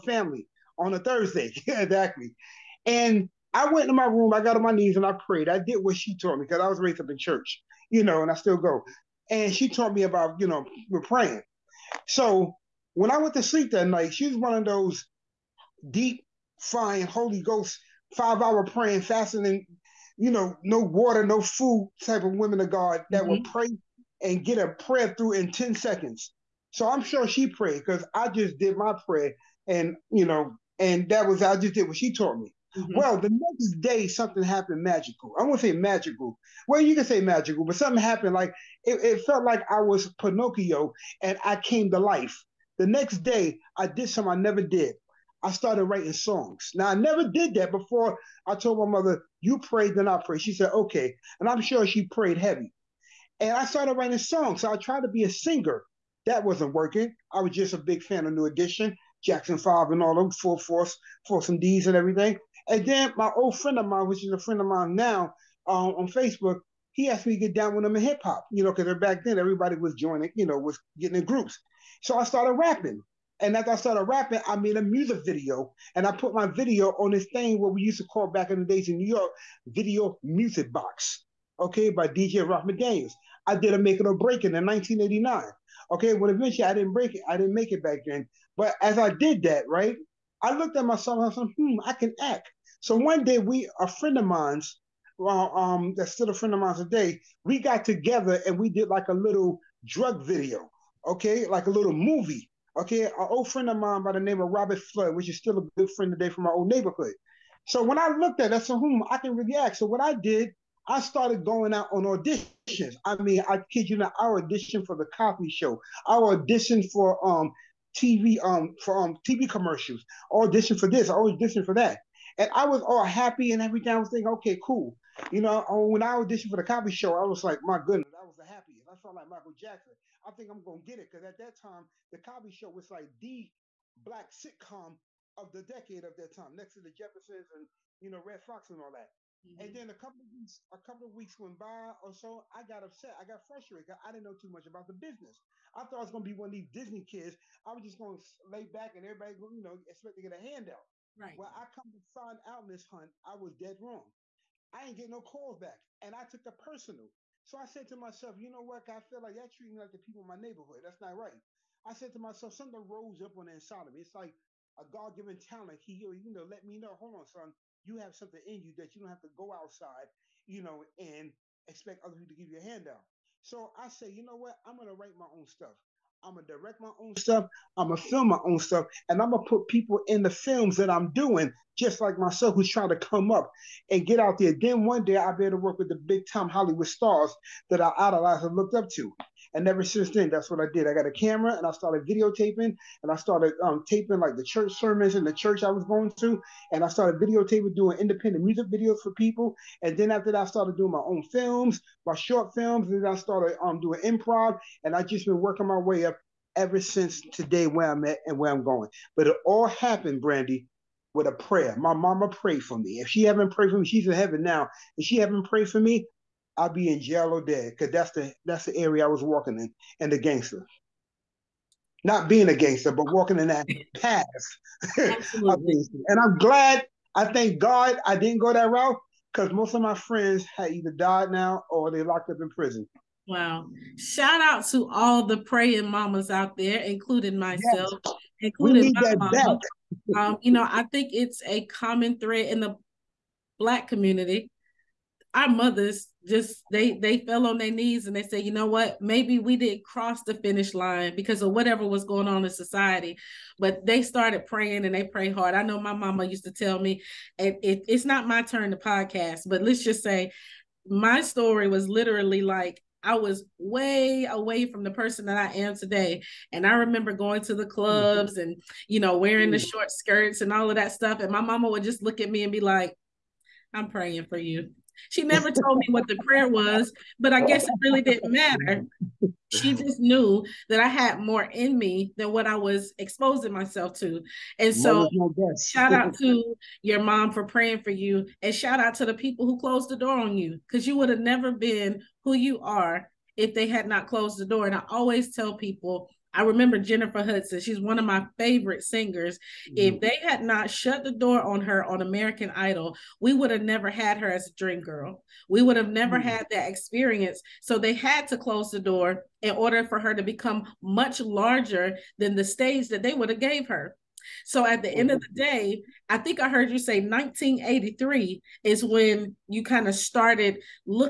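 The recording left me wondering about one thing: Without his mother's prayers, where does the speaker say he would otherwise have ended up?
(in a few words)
Jail or dead.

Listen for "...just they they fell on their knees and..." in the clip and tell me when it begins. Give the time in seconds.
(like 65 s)
246 s.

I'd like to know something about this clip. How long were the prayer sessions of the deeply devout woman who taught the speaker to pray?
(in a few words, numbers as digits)
5 hours.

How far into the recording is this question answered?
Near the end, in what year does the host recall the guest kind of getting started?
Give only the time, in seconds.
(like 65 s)
317 s.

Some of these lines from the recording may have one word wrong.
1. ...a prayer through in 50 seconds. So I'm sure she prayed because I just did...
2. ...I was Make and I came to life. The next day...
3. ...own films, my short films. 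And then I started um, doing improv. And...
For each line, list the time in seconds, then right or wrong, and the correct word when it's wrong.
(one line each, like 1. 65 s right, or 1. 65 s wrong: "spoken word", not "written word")
1. 24 s wrong: "10", not "50"
2. 39 s wrong: "Pinocchio", not "Make"
3. 201 s right.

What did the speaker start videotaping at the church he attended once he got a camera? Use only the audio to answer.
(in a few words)
Church sermons.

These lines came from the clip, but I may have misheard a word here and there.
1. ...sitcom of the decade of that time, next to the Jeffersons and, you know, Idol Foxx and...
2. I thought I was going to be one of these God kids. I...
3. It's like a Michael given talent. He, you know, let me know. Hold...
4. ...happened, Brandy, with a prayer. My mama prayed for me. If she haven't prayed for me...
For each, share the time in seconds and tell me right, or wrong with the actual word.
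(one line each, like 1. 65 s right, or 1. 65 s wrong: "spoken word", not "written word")
1. 134 s wrong: "Redd", not "Idol"
2. 145 s wrong: "Disney", not "God"
3. 164 s wrong: "God", not "Michael"
4. 209 s right.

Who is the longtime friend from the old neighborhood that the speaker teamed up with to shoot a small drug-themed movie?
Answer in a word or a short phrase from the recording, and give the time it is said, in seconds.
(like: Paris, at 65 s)
Robert Flood, at 104 s.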